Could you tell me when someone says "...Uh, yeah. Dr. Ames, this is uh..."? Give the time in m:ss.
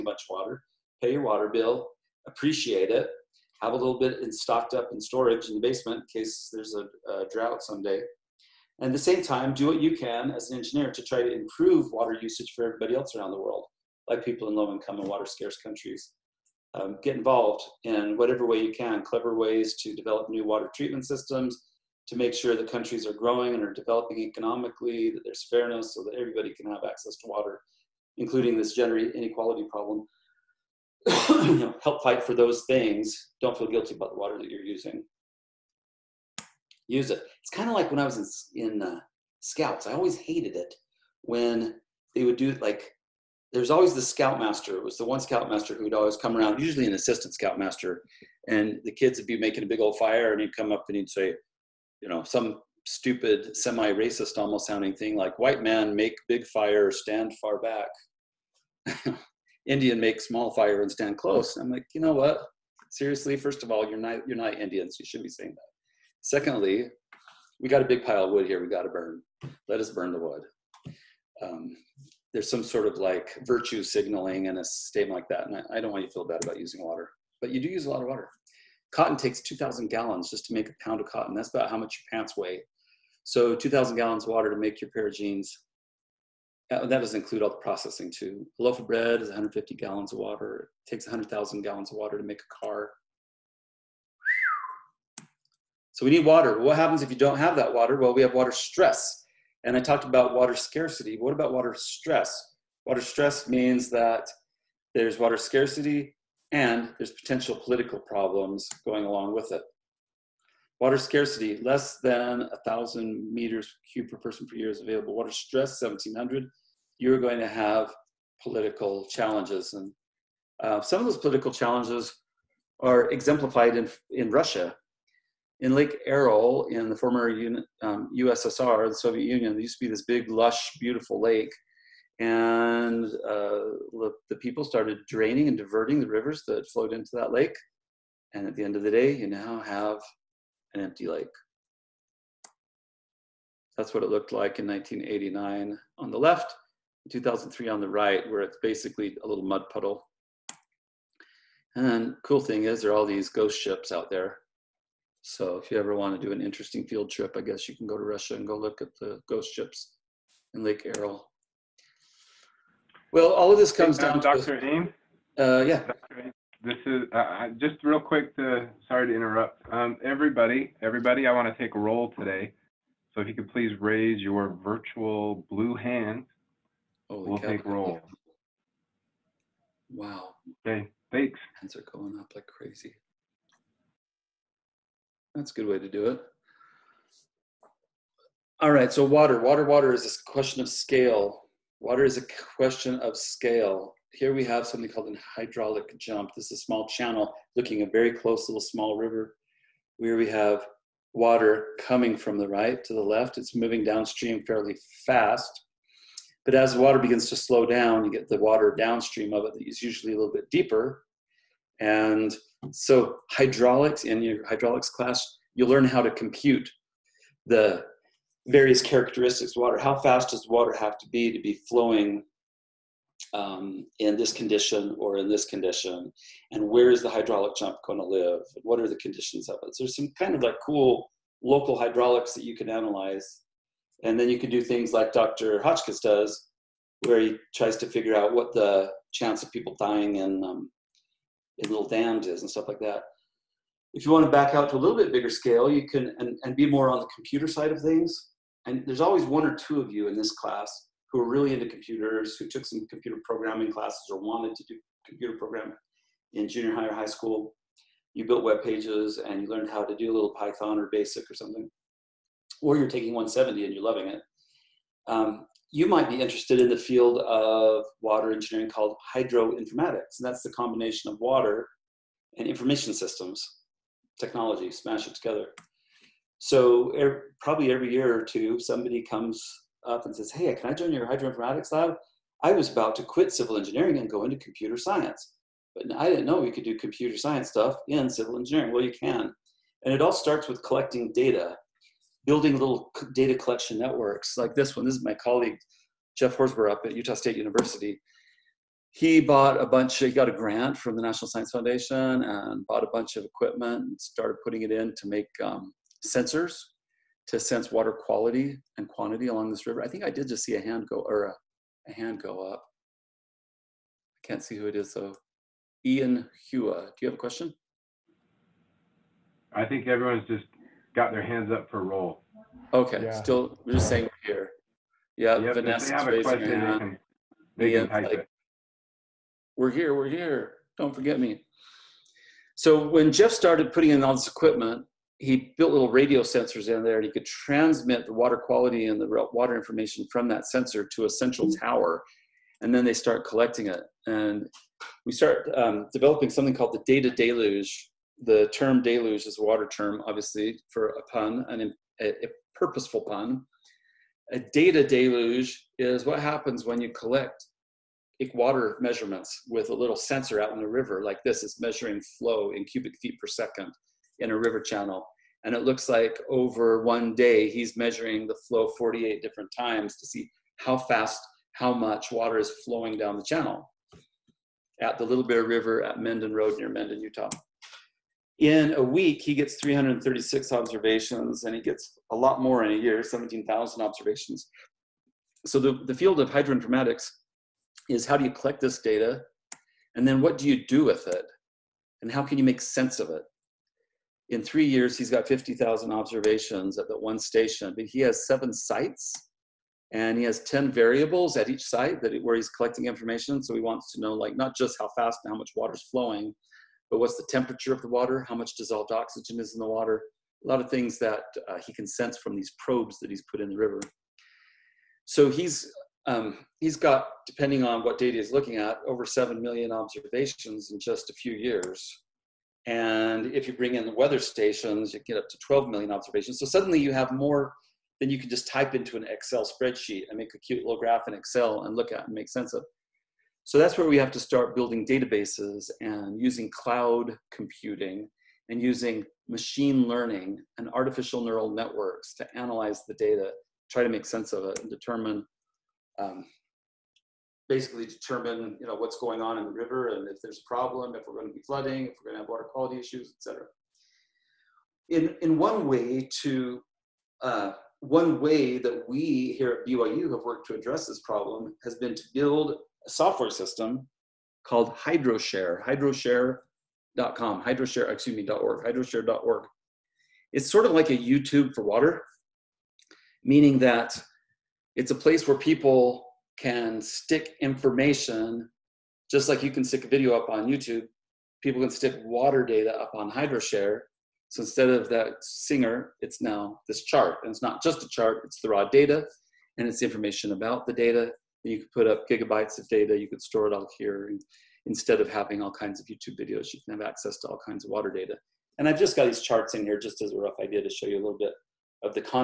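2:45.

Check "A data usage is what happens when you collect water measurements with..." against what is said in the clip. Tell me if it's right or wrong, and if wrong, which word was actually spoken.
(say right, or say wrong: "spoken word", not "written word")
wrong: "deluge", not "usage".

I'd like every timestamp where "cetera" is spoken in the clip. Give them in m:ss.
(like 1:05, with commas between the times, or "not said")
7:33.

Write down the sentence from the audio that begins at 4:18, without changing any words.
You built web pages and you learned how to do a little Python or BASIC or something.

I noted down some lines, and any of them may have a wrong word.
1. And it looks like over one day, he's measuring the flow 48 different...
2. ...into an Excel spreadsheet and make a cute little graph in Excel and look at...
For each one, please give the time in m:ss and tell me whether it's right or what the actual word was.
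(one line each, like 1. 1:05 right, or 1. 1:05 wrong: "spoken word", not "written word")
1. 6:05 right
2. 7:08 right.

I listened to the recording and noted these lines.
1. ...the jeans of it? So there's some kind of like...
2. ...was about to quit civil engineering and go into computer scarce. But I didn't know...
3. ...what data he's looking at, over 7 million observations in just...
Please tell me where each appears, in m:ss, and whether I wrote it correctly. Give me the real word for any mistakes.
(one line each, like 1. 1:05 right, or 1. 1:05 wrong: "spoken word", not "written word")
1. 3:48 wrong: "conditions", not "jeans"
2. 4:42 wrong: "science", not "scarce"
3. 6:57 right.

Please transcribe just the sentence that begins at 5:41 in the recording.
tower, and then they start collecting it.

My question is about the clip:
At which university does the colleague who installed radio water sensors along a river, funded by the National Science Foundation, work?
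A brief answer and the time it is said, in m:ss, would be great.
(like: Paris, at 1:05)
Utah State University, at 4:56.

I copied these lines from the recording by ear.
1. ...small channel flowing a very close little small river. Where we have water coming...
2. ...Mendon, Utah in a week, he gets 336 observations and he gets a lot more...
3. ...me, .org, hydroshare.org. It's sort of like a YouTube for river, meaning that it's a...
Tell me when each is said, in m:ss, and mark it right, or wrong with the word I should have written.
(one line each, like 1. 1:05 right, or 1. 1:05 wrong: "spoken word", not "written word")
1. 3:16 wrong: "looking", not "flowing"
2. 6:16 right
3. 7:48 wrong: "water", not "river".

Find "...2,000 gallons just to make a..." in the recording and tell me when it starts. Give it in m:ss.
1:19.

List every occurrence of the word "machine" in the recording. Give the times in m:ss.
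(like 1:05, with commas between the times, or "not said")
7:19.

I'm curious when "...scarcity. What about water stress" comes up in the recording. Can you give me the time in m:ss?
1:40.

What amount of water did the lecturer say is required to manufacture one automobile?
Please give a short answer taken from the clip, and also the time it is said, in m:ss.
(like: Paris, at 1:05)
100,000 gallons, at 1:31.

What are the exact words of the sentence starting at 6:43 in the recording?
So he wants to know like not just how fast and how much water's flowing, but what's the temperature of the water?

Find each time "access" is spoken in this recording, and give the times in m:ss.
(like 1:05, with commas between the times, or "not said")
0:26, 8:16.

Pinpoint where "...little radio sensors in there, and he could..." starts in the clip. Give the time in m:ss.
5:35.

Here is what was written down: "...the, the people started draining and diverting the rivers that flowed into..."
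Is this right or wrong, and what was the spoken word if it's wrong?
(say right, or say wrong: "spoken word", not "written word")
right.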